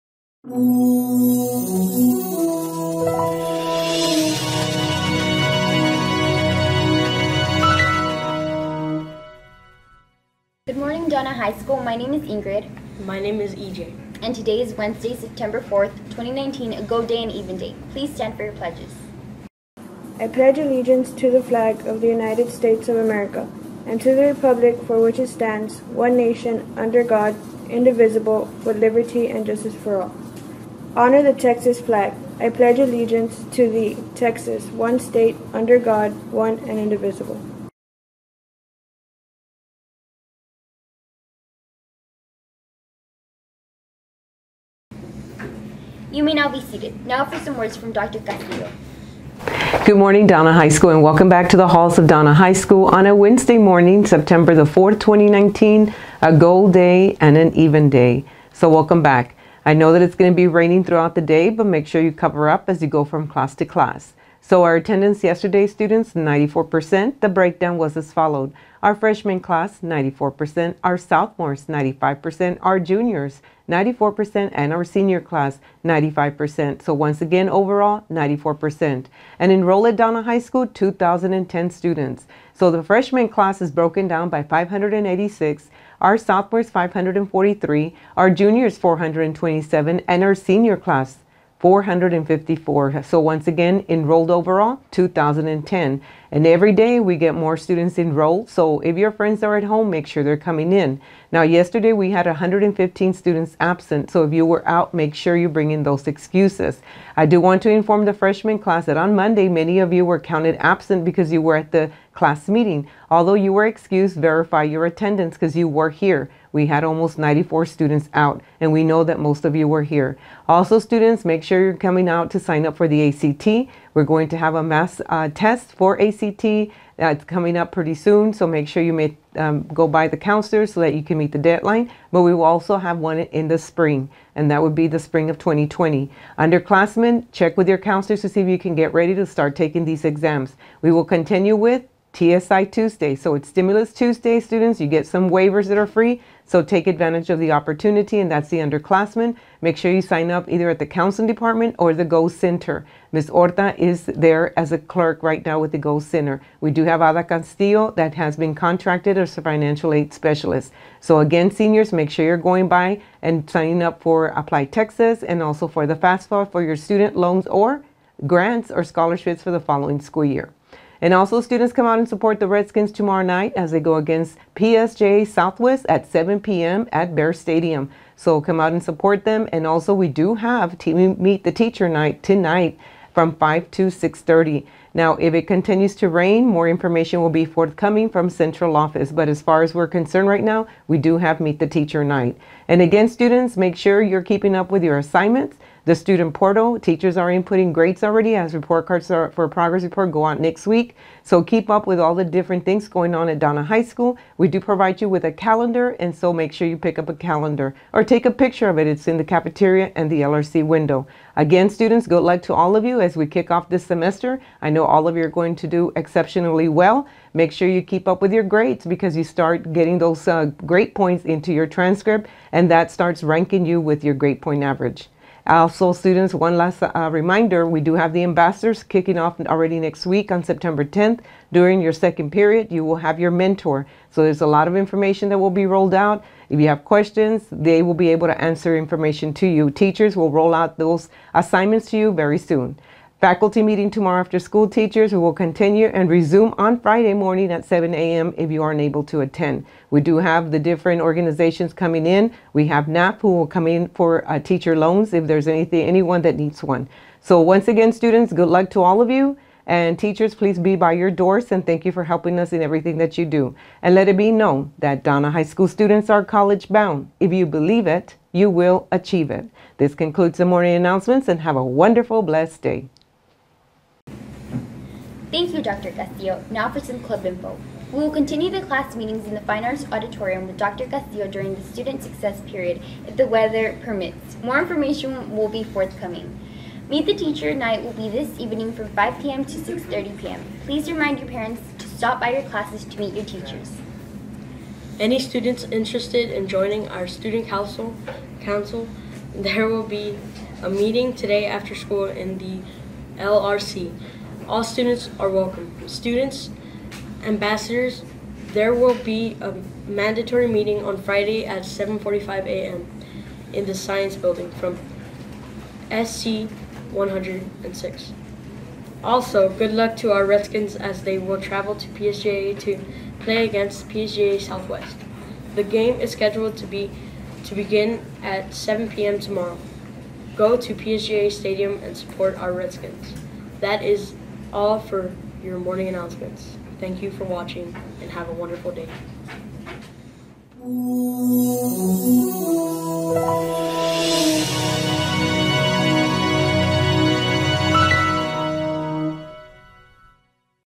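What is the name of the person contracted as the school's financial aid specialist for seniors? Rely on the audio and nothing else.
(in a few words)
Ada Castillo.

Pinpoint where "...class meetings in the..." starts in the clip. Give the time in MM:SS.
04:38.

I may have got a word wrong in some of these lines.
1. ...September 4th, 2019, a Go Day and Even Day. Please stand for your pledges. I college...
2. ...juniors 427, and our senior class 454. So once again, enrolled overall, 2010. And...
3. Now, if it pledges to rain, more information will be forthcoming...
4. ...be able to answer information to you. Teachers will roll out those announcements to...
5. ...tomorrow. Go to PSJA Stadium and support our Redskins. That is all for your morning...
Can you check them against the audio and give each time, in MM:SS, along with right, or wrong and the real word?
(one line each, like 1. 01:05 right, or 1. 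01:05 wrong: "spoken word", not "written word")
1. 00:15 wrong: "pledge", not "college"
2. 01:28 right
3. 03:04 wrong: "continues", not "pledges"
4. 03:57 wrong: "assignments", not "announcements"
5. 05:29 right.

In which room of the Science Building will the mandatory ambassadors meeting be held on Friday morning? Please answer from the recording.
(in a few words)
SC 106.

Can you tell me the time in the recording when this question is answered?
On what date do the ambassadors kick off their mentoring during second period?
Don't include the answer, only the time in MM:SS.
03:50.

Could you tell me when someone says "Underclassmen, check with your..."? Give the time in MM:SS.
02:16.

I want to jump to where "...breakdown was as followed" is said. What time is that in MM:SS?
01:07.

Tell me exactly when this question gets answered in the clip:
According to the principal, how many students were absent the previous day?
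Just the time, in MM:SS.
01:42.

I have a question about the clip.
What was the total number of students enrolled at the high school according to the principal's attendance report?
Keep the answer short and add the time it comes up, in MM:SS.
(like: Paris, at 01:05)
2,010, at 01:20.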